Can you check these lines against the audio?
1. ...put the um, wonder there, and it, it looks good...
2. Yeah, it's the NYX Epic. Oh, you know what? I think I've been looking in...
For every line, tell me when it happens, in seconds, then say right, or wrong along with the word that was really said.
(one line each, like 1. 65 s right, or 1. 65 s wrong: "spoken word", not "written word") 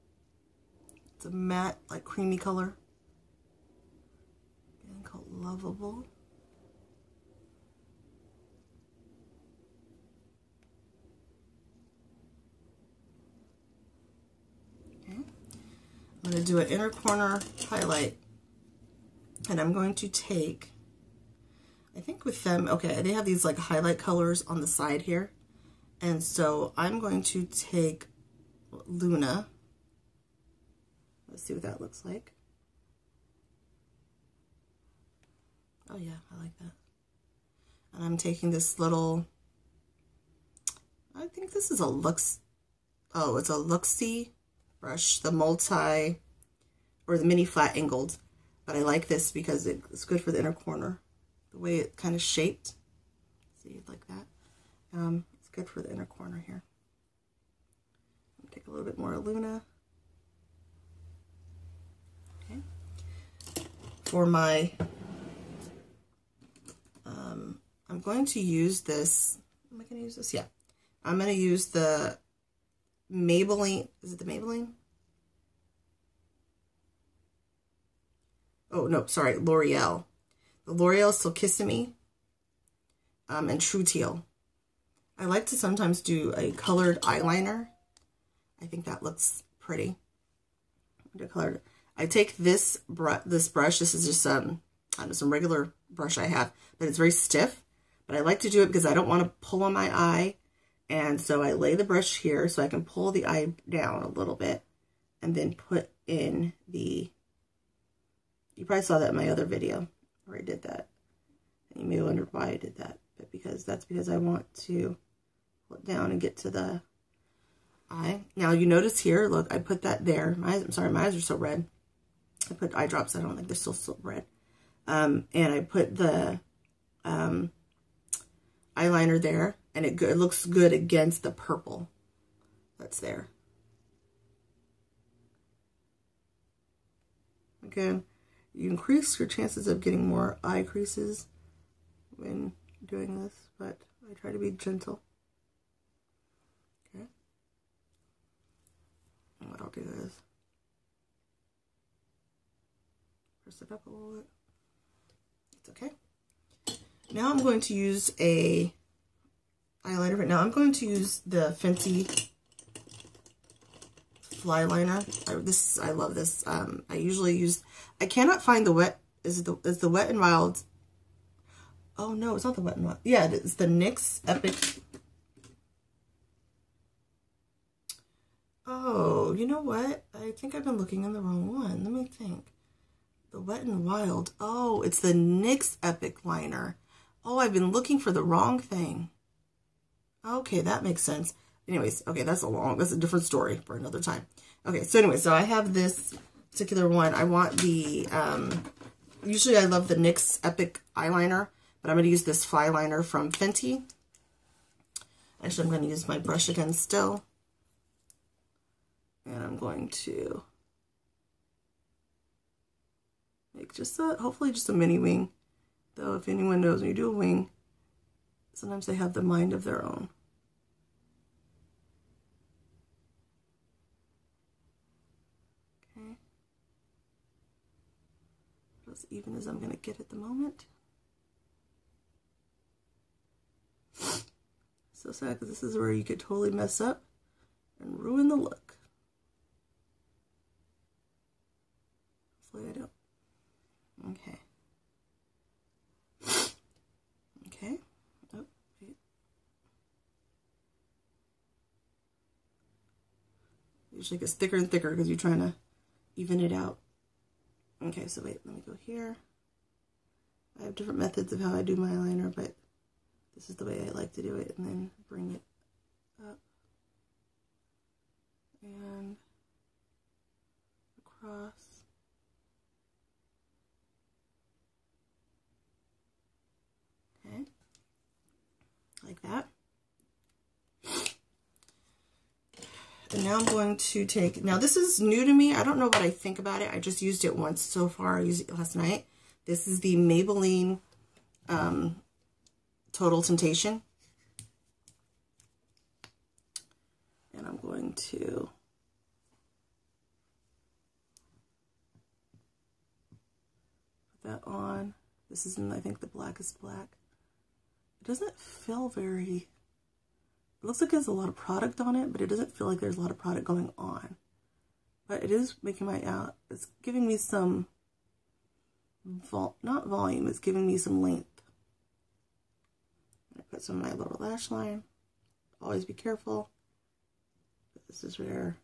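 1. 125 s wrong: "eyeliner", not "wonder"
2. 173 s right.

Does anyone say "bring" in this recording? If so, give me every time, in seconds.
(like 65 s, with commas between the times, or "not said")
265 s.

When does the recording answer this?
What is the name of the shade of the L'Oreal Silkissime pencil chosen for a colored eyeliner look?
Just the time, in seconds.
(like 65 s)
83 s.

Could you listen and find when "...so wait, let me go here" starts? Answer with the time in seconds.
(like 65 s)
258 s.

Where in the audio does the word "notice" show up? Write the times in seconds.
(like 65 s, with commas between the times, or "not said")
118 s.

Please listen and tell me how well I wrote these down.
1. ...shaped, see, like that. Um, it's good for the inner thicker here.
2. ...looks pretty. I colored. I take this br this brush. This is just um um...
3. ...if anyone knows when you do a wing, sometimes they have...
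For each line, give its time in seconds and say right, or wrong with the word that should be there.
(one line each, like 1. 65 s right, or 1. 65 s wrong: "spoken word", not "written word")
1. 52 s wrong: "corner", not "thicker"
2. 89 s right
3. 216 s right.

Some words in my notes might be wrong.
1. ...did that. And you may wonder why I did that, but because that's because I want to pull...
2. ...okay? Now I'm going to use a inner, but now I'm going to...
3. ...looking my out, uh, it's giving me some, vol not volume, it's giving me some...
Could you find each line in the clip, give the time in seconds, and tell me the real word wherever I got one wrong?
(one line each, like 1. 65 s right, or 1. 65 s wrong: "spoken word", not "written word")
1. 110 s right
2. 155 s wrong: "eyeliner", not "inner"
3. 315 s wrong: "making", not "looking".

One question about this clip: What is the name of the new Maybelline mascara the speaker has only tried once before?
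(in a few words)
Total Temptation.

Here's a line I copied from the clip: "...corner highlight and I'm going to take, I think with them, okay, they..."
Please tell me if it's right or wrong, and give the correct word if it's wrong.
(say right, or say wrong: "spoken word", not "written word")
right.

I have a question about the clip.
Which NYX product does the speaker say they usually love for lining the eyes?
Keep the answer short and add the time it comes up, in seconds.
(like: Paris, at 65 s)
NYX Epic Eyeliner, at 199 s.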